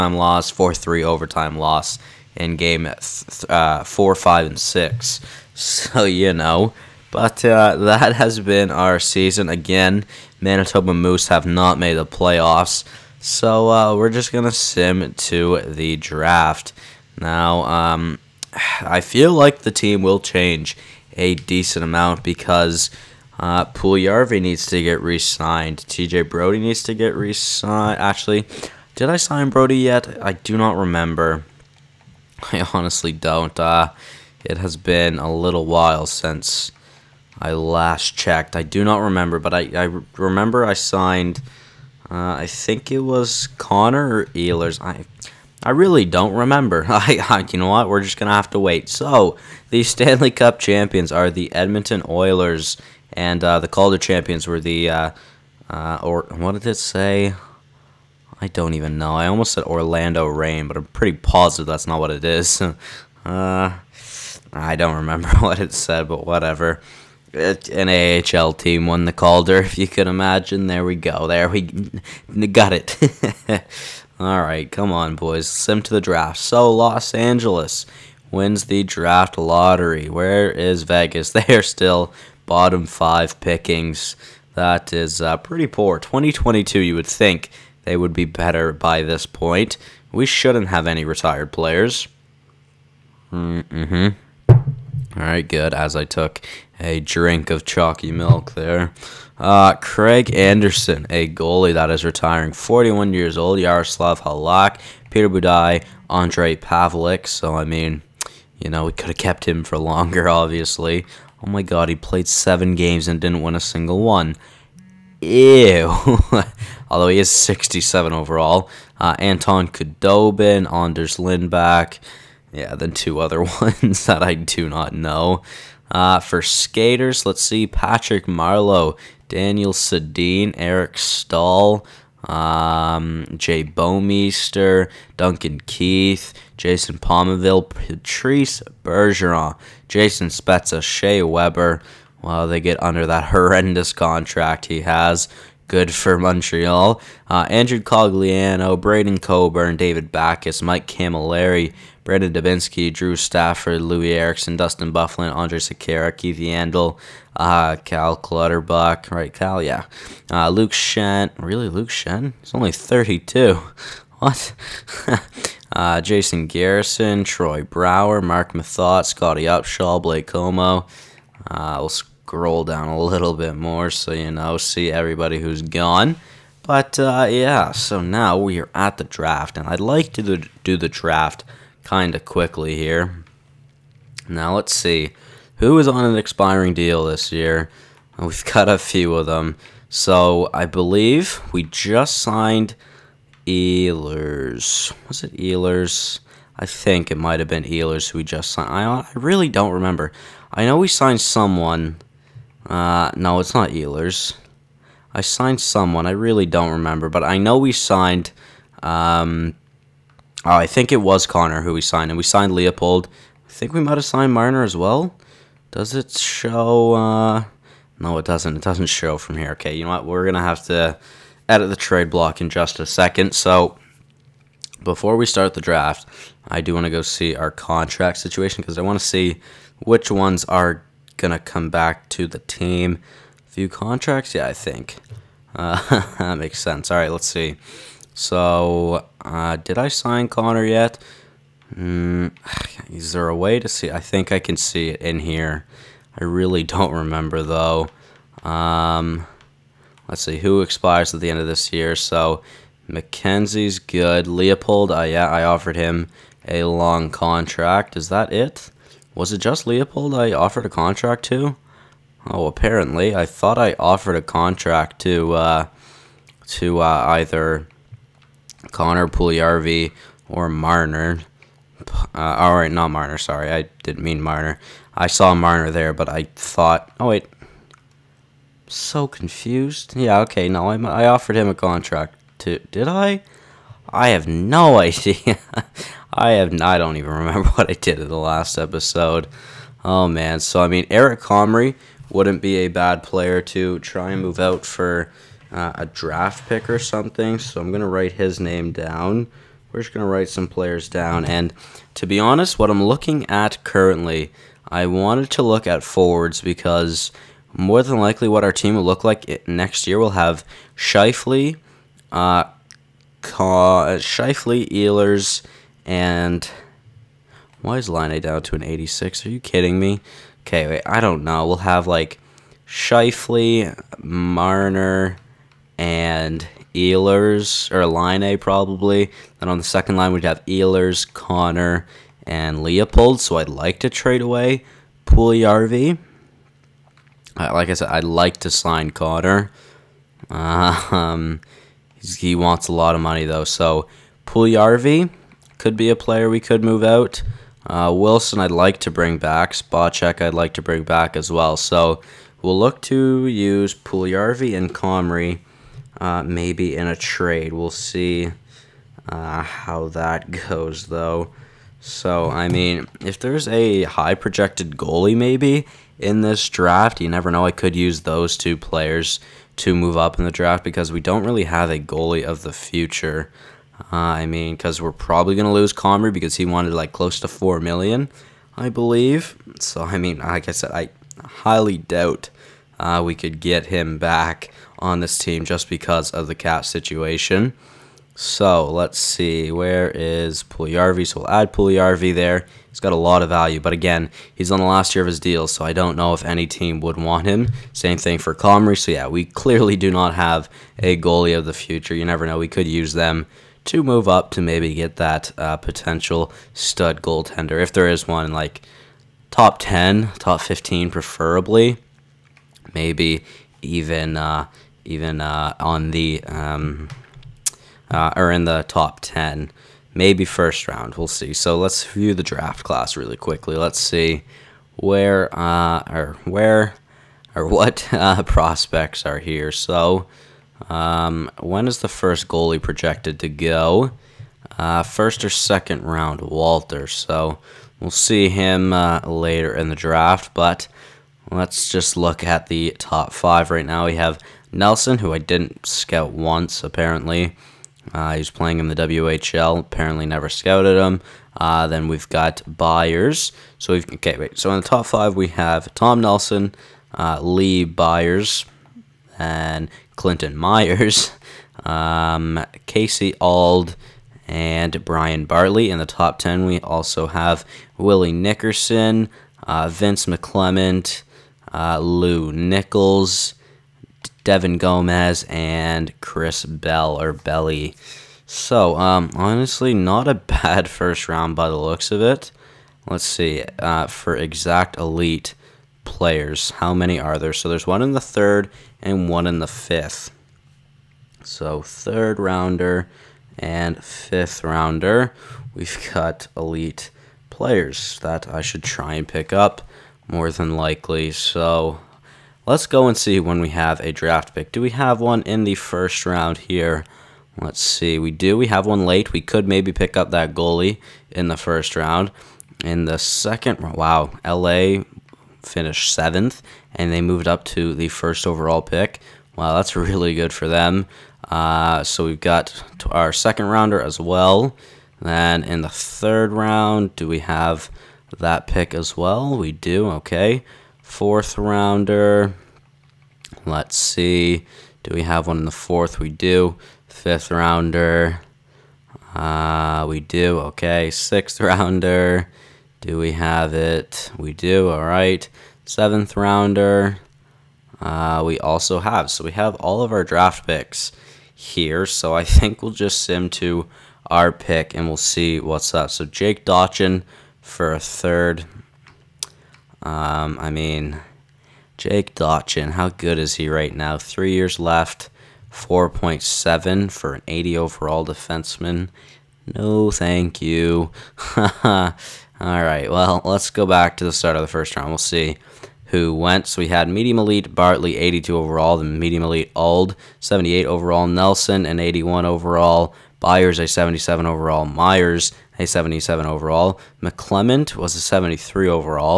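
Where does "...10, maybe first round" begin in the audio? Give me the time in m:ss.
6:59.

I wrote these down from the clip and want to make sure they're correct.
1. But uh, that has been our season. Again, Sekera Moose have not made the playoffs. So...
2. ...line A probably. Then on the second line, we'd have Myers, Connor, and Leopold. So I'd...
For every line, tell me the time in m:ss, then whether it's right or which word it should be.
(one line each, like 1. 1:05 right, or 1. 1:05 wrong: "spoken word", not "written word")
1. 0:07 wrong: "Manitoba", not "Sekera"
2. 5:27 wrong: "Ehlers", not "Myers".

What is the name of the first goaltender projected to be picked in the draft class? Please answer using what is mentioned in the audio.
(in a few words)
Walter.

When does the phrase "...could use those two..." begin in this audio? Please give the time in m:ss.
6:07.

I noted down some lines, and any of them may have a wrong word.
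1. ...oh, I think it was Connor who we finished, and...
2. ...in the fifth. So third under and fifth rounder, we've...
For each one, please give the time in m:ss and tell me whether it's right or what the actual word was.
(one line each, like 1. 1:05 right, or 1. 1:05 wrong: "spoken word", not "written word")
1. 3:30 wrong: "signed", not "finished"
2. 8:09 wrong: "rounder", not "under".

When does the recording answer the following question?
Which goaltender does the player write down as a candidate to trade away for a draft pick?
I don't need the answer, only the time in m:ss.
4:50.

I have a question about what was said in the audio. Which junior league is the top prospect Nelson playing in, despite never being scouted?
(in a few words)
WHL.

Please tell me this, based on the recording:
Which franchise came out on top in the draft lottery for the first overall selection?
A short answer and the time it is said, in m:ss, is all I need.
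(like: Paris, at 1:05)
Los Angeles, at 1:16.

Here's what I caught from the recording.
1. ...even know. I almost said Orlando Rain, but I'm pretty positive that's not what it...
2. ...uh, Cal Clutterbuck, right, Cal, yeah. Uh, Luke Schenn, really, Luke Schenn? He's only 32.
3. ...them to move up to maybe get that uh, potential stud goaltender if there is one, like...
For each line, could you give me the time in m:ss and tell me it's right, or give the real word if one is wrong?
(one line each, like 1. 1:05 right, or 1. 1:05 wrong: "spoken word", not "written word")
1. 0:58 right
2. 2:37 right
3. 6:42 right.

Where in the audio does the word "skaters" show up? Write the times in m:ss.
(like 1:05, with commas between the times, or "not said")
2:06.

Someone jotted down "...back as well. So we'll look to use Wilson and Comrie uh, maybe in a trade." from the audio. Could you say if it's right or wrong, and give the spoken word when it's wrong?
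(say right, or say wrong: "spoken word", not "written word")
wrong: "Puljujarvi", not "Wilson".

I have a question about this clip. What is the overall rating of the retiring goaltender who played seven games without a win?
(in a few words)
67.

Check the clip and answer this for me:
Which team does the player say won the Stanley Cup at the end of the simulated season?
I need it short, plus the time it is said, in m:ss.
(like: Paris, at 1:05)
Edmonton Oilers, at 0:51.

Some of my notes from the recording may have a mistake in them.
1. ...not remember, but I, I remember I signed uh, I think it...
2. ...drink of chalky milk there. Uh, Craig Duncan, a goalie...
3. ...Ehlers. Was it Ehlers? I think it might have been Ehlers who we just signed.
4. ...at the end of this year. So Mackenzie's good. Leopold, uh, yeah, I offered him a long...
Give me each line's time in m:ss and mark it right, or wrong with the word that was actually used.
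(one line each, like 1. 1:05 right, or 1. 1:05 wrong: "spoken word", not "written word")
1. 0:38 right
2. 1:36 wrong: "Anderson", not "Duncan"
3. 3:13 right
4. 4:11 right.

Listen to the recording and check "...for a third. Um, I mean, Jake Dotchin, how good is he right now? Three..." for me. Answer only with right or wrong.
right.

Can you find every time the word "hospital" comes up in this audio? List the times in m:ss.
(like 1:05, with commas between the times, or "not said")
not said.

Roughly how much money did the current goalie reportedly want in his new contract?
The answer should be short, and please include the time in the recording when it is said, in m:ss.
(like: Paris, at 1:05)
4 million, at 6:17.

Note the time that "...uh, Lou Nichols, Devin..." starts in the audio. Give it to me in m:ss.
7:51.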